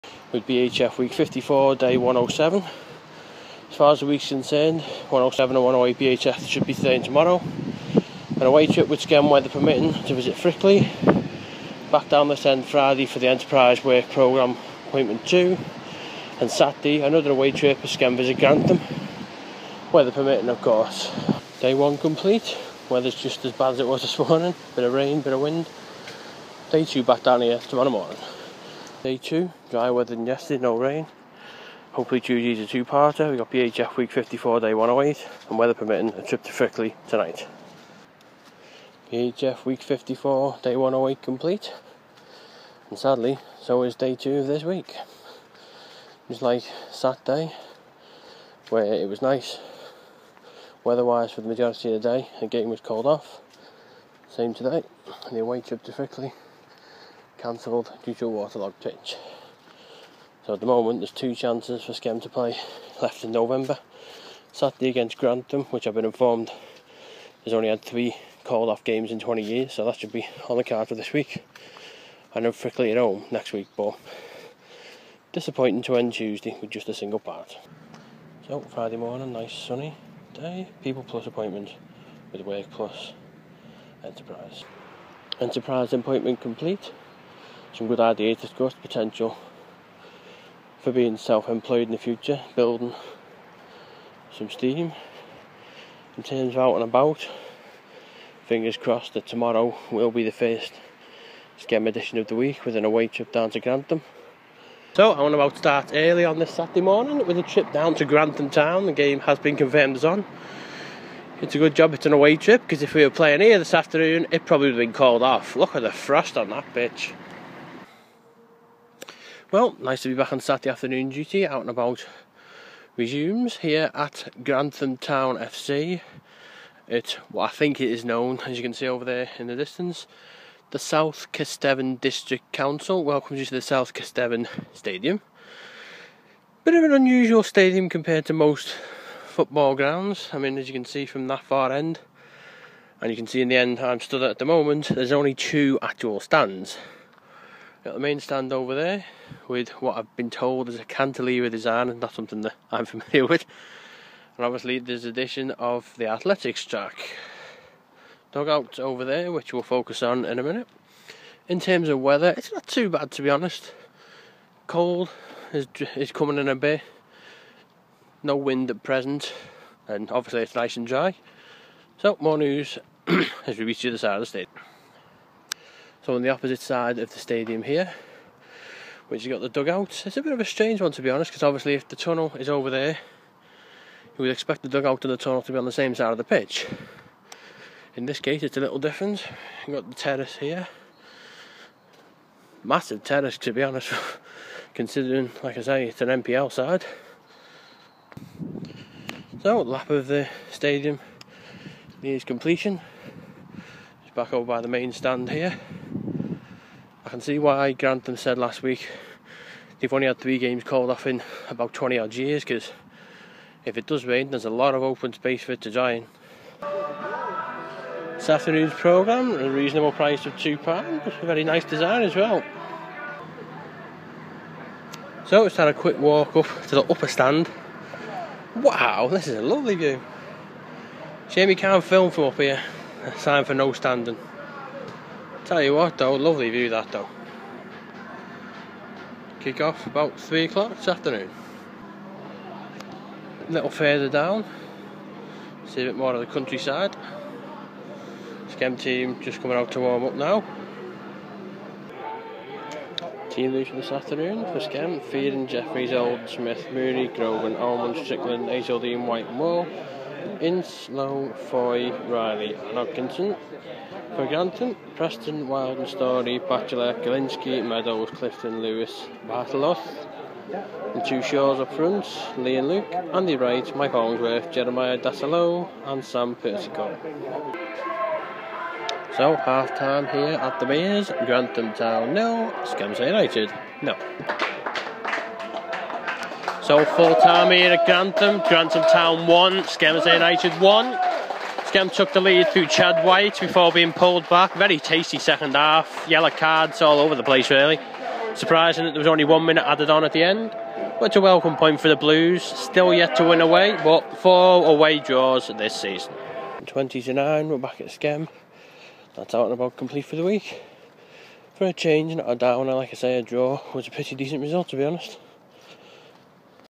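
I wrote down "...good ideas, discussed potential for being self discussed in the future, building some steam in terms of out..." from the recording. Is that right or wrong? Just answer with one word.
wrong.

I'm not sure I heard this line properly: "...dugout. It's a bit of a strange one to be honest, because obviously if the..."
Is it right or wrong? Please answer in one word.
right.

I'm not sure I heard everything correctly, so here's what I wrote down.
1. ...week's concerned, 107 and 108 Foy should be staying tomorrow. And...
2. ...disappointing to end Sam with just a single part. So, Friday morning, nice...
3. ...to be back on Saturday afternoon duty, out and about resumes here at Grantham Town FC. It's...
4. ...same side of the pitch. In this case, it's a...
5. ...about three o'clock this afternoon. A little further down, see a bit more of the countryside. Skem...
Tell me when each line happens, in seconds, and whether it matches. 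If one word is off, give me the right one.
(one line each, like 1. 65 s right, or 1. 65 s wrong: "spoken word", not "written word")
1. 4 s wrong: "BHF", not "Foy"
2. 75 s wrong: "Tuesday", not "Sam"
3. 120 s right
4. 185 s right
5. 239 s right.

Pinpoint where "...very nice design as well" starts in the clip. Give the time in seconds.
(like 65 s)
221 s.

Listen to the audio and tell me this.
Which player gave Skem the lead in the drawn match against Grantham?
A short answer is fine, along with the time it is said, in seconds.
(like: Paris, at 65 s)
Chad White, at 292 s.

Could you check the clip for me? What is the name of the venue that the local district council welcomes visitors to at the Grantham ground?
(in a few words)
South Kesteven Stadium.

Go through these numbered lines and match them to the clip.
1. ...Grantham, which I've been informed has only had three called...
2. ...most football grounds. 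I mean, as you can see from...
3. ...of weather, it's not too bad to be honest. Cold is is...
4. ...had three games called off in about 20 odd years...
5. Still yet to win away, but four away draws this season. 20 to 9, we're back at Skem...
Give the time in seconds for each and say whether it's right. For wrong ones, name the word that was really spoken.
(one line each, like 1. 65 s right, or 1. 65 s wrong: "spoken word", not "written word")
1. 65 s right
2. 138 s right
3. 161 s right
4. 210 s right
5. 302 s right.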